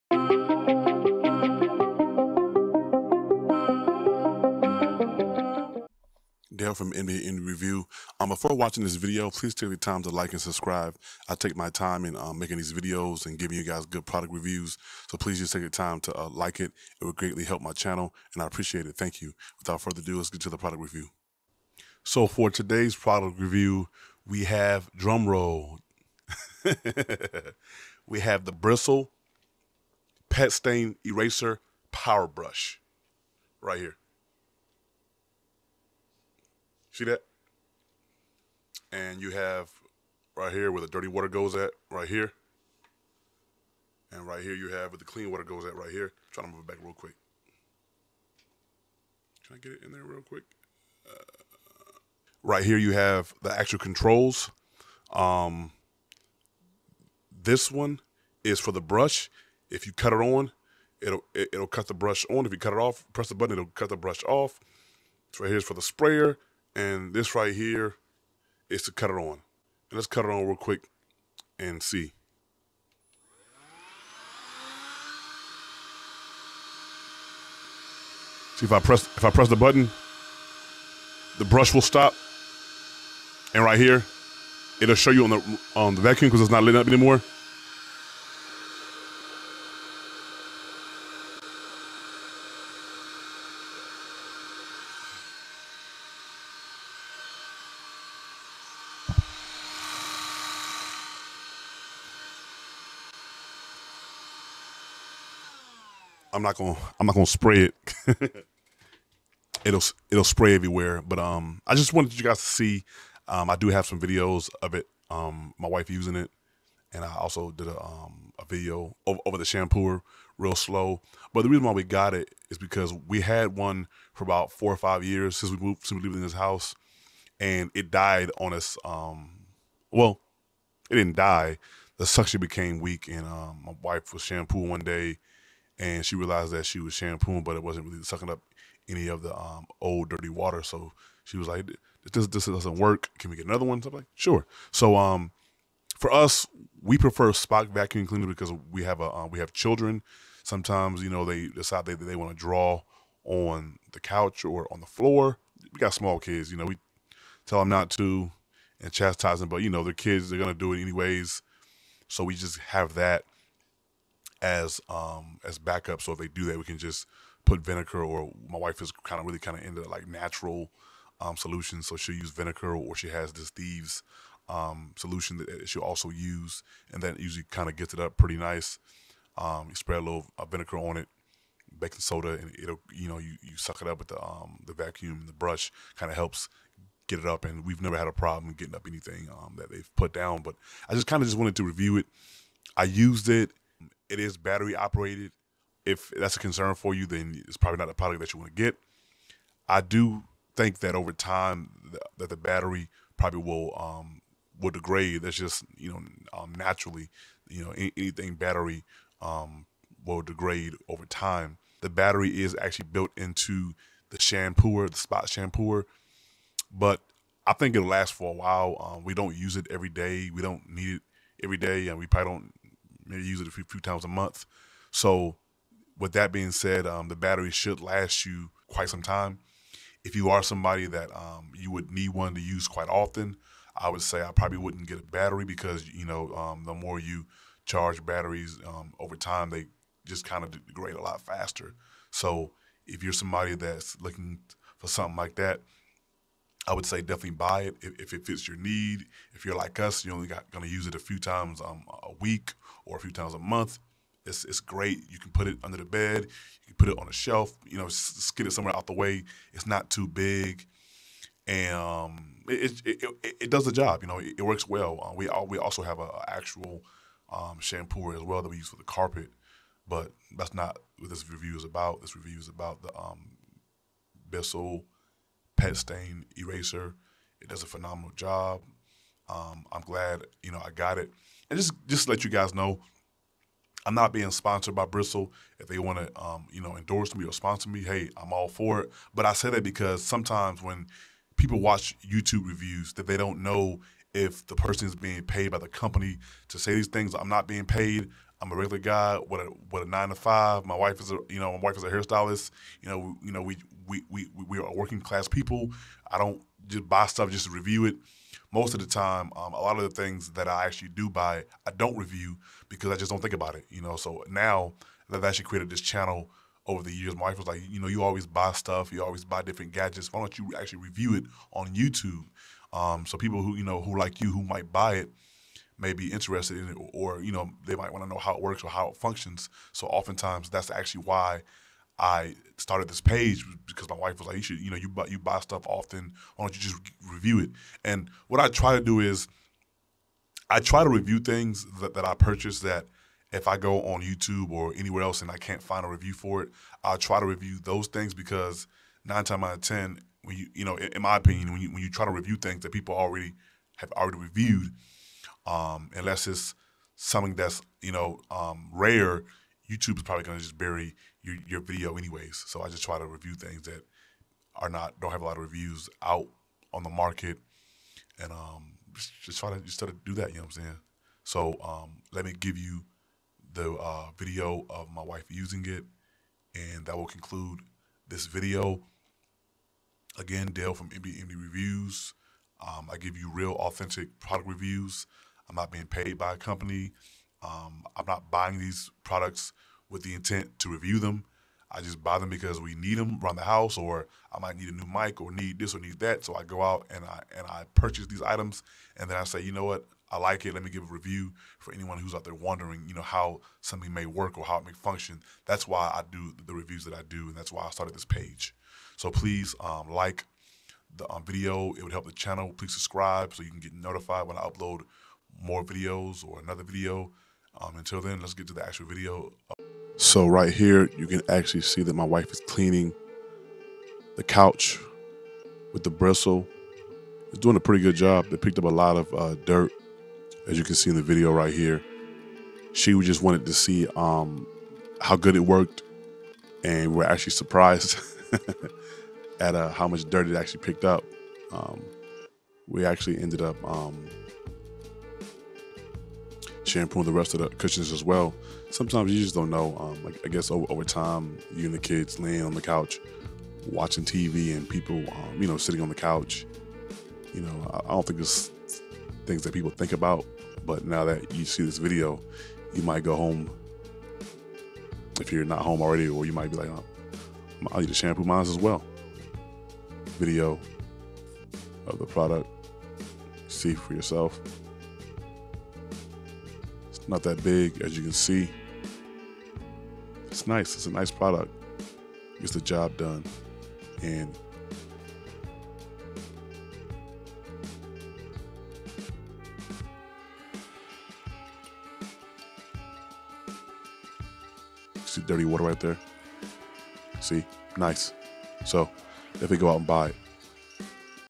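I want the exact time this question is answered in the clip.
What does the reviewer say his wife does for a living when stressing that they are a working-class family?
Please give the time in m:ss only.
5:01.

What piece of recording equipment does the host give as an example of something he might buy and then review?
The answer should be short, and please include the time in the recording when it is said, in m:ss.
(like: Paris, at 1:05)
a new mic, at 6:34.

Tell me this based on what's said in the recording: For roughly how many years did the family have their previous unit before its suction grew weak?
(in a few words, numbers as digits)
4 or 5.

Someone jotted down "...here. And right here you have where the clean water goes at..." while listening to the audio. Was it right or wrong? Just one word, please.
right.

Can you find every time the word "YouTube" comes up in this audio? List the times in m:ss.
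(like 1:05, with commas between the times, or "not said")
4:52, 5:21, 5:44, 5:59.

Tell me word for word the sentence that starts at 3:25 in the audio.
That's just you know um, naturally, you know anything battery um, will degrade over time.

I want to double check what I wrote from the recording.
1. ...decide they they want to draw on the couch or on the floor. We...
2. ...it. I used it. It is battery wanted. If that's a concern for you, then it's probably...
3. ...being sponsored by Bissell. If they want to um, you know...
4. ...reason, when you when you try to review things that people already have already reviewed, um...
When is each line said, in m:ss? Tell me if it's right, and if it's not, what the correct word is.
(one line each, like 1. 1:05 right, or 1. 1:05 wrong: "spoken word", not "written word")
1. 2:31 right
2. 3:11 wrong: "operated", not "wanted"
3. 4:44 right
4. 5:51 wrong: "opinion", not "reason".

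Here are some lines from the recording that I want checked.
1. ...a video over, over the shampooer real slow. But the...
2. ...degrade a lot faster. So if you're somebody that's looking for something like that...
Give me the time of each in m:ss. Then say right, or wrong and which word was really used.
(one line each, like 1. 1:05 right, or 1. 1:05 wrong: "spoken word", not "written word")
1. 1:58 right
2. 4:00 right.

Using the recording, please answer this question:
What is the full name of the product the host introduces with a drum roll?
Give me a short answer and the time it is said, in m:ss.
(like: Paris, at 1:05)
Bissell Pet Stain Eraser Power Brush, at 0:28.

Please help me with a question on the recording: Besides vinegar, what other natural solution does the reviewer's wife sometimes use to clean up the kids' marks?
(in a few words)
thieves.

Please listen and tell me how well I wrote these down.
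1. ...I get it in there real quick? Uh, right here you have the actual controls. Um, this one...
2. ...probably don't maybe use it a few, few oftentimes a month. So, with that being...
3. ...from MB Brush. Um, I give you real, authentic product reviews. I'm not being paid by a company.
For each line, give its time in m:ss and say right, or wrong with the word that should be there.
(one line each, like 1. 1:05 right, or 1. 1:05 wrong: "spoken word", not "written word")
1. 0:49 right
2. 3:42 wrong: "times", not "oftentimes"
3. 6:20 wrong: "Reviews", not "Brush".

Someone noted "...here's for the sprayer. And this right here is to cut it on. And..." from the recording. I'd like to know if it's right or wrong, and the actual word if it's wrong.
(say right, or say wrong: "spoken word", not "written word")
right.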